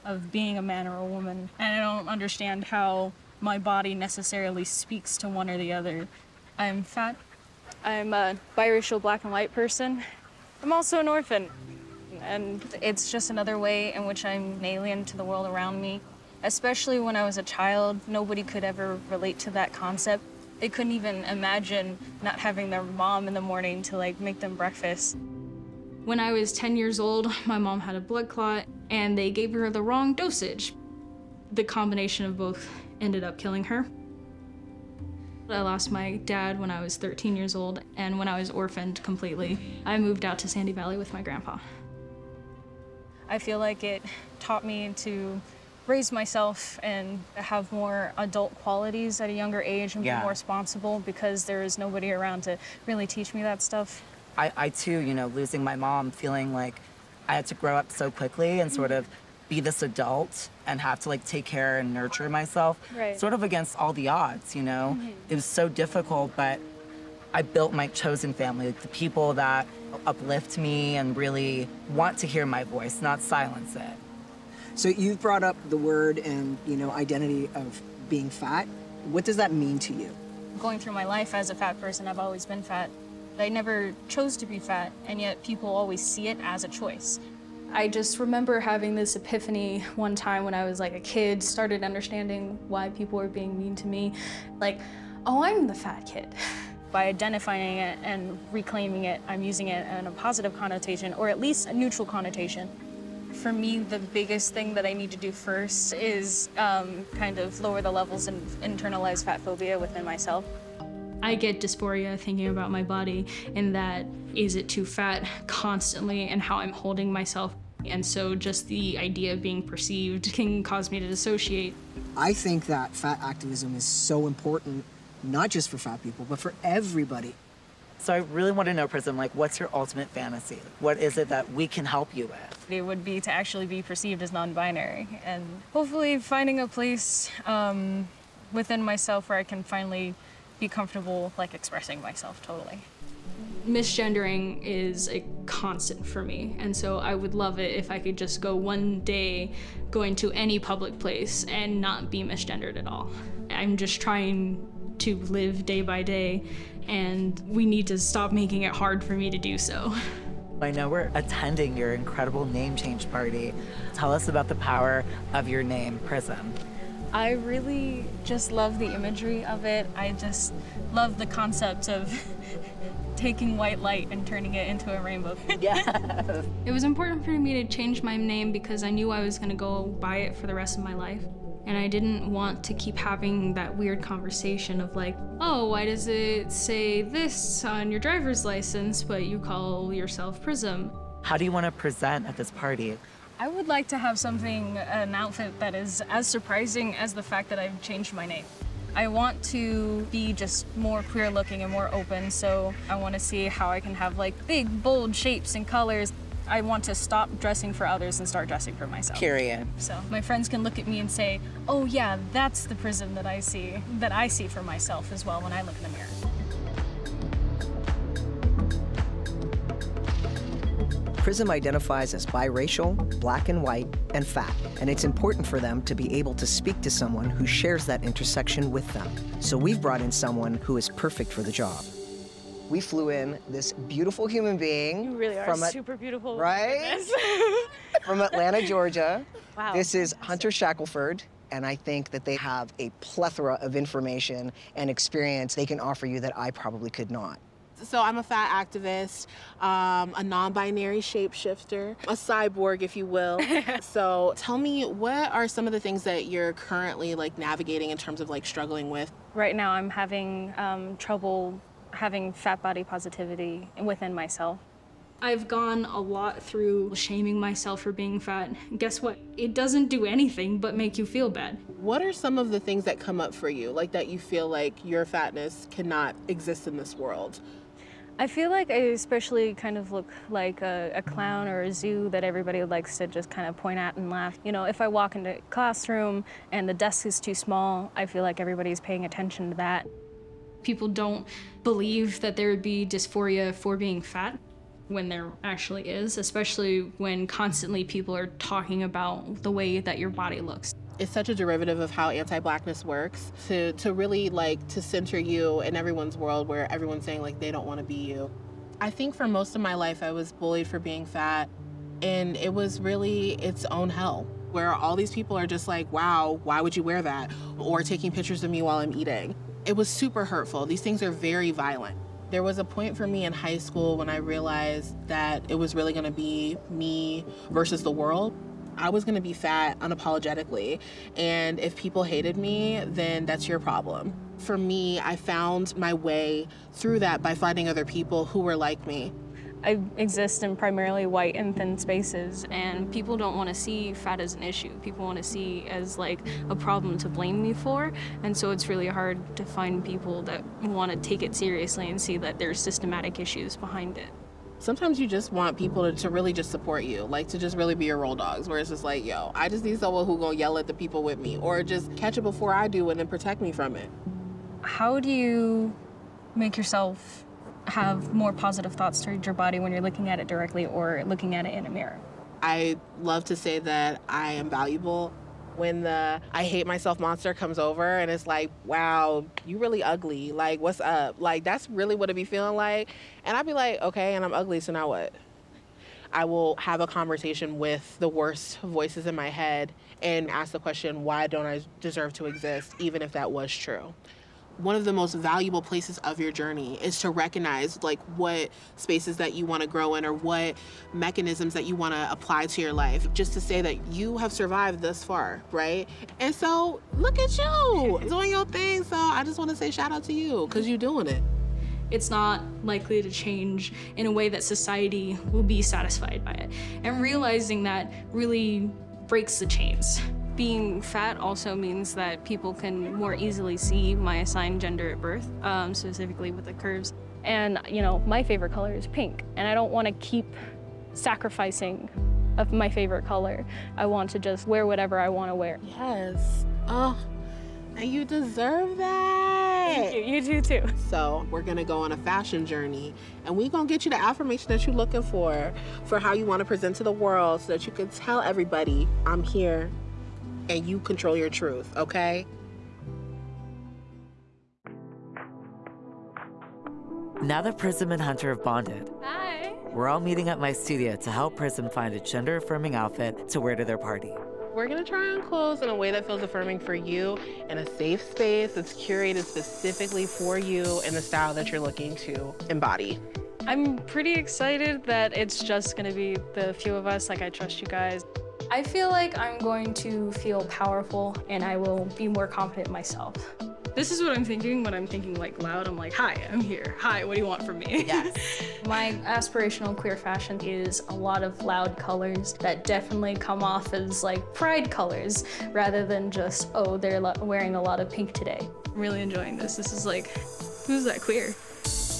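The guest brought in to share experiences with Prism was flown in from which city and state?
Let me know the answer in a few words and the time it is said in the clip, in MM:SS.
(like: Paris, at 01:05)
Atlanta, Georgia, at 03:58.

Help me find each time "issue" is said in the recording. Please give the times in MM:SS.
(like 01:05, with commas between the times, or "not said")
05:44, 05:53.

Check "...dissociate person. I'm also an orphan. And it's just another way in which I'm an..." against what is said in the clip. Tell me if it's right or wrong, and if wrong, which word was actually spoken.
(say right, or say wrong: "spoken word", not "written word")
wrong: "white", not "dissociate".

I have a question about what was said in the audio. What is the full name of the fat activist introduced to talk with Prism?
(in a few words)
Hunter Shackelford.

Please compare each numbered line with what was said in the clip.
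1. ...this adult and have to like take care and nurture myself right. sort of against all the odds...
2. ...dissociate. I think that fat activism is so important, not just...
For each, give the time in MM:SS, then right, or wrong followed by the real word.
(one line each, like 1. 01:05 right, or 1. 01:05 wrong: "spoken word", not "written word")
1. 00:59 right
2. 02:01 right.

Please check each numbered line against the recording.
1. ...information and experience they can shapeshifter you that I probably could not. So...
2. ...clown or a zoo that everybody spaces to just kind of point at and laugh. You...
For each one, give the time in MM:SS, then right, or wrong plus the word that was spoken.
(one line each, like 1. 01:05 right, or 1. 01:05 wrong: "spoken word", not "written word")
1. 04:03 wrong: "offer", not "shapeshifter"
2. 04:41 wrong: "likes", not "spaces".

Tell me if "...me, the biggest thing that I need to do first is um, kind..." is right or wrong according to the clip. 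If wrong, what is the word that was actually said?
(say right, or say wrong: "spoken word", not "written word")
right.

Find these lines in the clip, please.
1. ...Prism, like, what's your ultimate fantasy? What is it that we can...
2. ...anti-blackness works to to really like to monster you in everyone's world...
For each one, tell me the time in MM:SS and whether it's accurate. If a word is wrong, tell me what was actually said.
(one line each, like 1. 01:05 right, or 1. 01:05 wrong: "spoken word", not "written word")
1. 02:08 right
2. 05:02 wrong: "center", not "monster".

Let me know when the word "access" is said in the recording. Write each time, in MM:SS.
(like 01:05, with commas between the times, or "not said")
not said.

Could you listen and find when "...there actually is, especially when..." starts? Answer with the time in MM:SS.
04:55.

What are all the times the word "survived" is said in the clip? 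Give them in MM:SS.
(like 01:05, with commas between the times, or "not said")
06:44.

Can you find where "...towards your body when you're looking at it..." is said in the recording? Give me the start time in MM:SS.
06:09.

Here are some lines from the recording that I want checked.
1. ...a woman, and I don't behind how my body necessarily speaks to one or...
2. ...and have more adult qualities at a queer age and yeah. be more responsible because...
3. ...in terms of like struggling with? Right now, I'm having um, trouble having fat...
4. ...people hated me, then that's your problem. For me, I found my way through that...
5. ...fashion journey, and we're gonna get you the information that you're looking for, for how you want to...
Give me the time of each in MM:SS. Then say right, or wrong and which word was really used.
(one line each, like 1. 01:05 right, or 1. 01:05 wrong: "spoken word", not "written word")
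1. 00:00 wrong: "understand", not "behind"
2. 00:46 wrong: "younger", not "queer"
3. 04:17 right
4. 05:31 right
5. 07:21 wrong: "affirmation", not "information".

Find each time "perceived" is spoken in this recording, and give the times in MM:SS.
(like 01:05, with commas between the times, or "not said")
01:59, 02:13.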